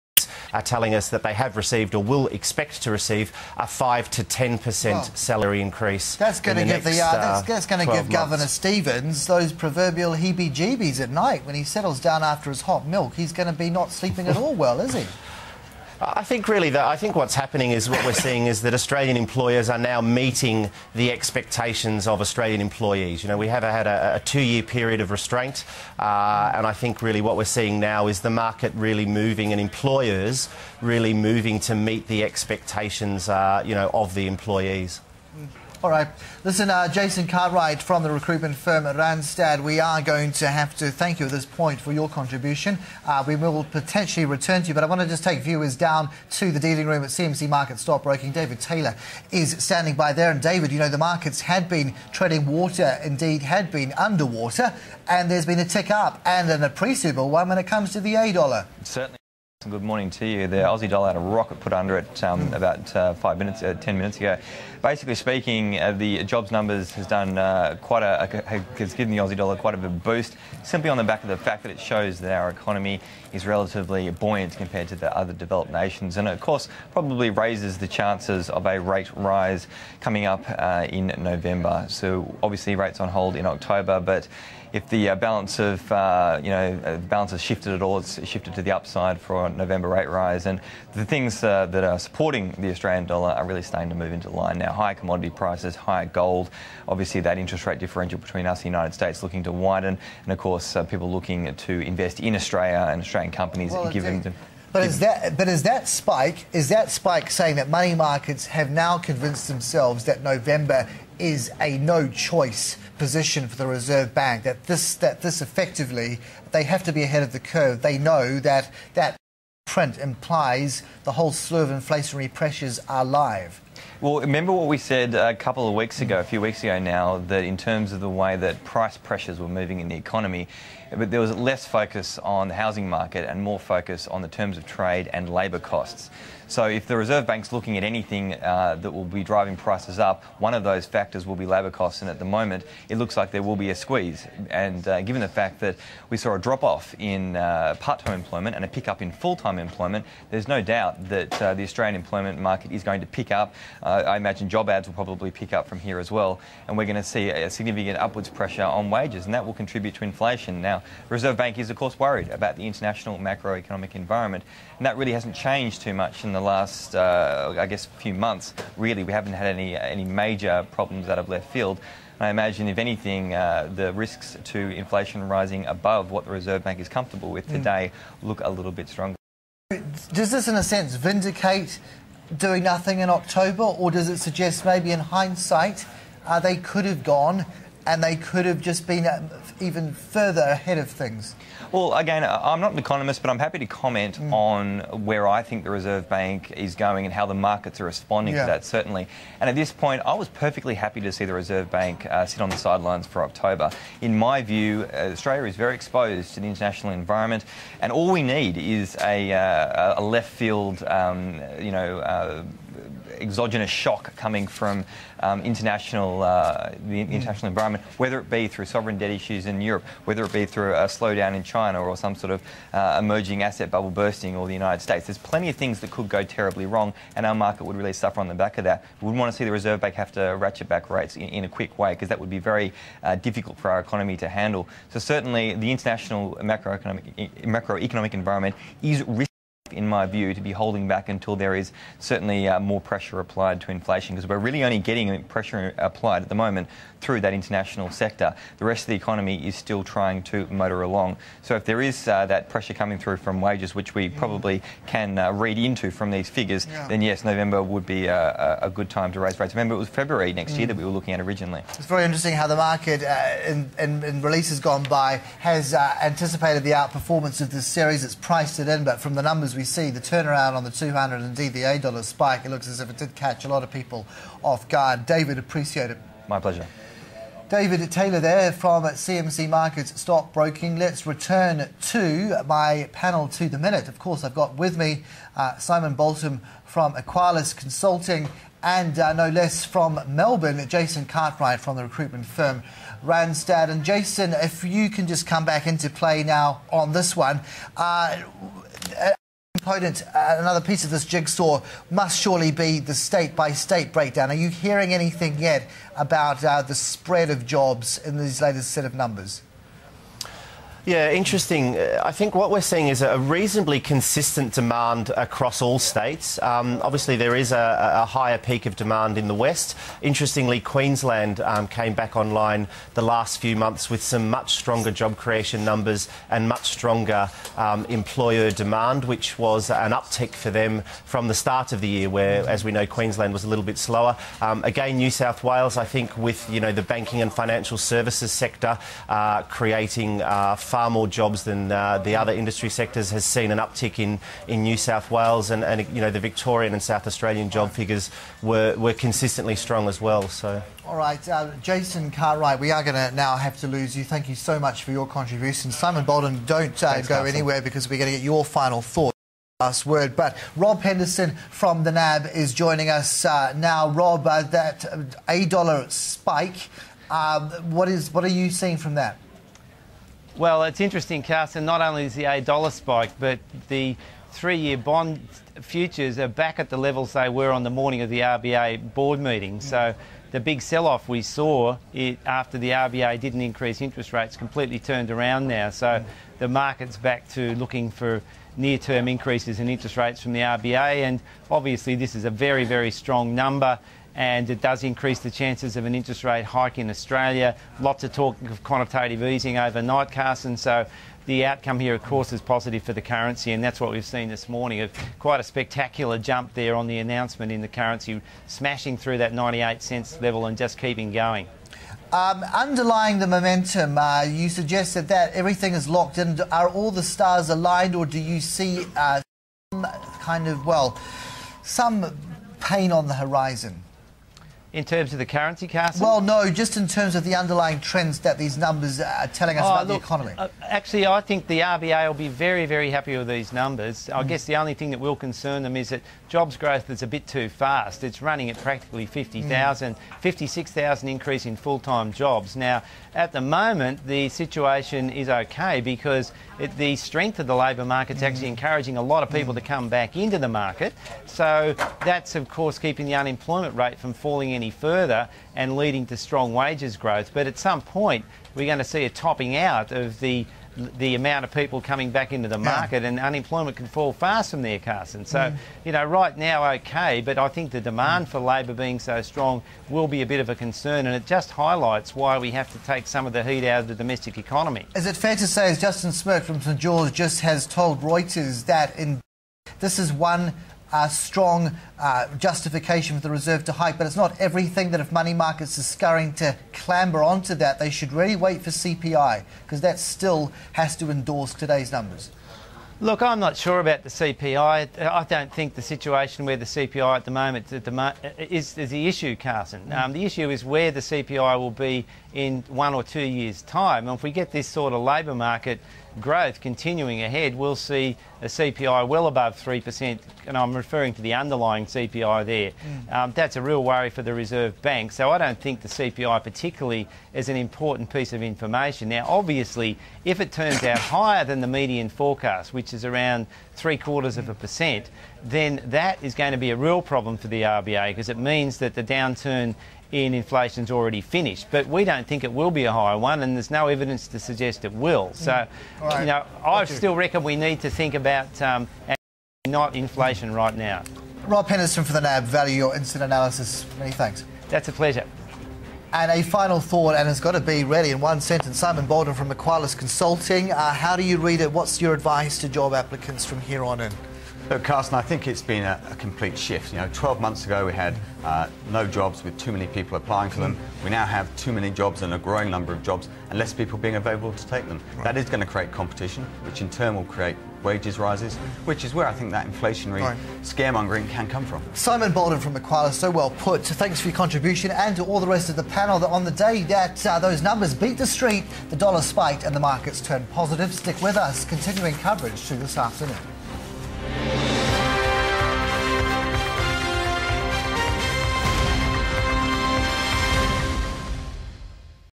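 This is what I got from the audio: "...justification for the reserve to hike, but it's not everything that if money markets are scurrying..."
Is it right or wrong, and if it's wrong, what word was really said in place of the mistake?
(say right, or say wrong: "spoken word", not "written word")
right.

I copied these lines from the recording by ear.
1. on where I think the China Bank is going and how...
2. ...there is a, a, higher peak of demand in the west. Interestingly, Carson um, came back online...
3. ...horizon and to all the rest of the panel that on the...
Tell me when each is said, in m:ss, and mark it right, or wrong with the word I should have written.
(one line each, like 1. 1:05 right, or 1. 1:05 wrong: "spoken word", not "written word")
1. 3:14 wrong: "Reserve", not "China"
2. 5:17 wrong: "Queensland", not "Carson"
3. 9:34 wrong: "contribution", not "horizon".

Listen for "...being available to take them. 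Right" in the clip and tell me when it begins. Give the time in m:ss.
9:23.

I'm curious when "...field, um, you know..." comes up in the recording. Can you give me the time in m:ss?
3:30.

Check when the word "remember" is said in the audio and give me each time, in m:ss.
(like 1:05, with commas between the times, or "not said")
2:04, 4:19.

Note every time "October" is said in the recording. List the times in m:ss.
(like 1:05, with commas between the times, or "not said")
1:23, 3:03, 3:23.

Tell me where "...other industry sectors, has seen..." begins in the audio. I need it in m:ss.
5:42.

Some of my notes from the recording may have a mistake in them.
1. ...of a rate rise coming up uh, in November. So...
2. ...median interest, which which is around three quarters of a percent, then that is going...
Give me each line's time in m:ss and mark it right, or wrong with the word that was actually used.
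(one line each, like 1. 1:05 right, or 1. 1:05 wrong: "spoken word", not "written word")
1. 1:18 right
2. 8:41 wrong: "forecast", not "interest".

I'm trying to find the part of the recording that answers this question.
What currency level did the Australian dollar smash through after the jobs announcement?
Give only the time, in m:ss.
6:49.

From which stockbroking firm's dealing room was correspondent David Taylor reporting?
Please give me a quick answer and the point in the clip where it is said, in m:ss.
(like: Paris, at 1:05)
CMC Markets, at 0:47.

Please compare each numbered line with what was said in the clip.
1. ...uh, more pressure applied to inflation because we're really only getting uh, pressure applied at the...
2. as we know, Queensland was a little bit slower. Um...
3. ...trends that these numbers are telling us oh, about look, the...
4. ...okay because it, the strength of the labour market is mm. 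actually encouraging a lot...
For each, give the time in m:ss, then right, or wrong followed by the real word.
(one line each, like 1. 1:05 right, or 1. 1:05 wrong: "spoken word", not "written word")
1. 4:02 right
2. 5:32 right
3. 7:07 right
4. 7:25 right.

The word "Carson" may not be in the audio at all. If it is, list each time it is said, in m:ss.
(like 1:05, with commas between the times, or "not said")
5:57, 6:11, 6:40, 7:44, 8:19, 9:14.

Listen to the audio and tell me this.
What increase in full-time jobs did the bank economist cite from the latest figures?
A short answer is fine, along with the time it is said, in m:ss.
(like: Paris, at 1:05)
56,000, at 7:20.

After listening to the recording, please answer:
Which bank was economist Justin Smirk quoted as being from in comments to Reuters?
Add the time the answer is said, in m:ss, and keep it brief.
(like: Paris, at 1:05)
St George, at 7:56.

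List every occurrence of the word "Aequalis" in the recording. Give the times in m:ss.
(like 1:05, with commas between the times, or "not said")
4:46, 9:09.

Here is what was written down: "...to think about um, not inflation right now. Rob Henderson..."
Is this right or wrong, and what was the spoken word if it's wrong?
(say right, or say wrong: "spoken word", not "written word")
right.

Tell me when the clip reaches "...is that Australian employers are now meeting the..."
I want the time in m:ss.
0:18.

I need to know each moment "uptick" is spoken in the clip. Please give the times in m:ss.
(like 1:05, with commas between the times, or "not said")
5:29, 5:43.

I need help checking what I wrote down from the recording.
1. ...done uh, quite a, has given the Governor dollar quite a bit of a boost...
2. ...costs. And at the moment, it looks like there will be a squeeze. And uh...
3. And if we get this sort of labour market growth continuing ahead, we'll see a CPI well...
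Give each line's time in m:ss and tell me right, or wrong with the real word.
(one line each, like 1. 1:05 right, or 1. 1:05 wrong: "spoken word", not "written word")
1. 1:07 wrong: "Aussie", not "Governor"
2. 2:21 right
3. 8:24 right.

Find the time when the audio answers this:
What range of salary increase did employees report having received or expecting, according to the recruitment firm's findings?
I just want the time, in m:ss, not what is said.
0:03.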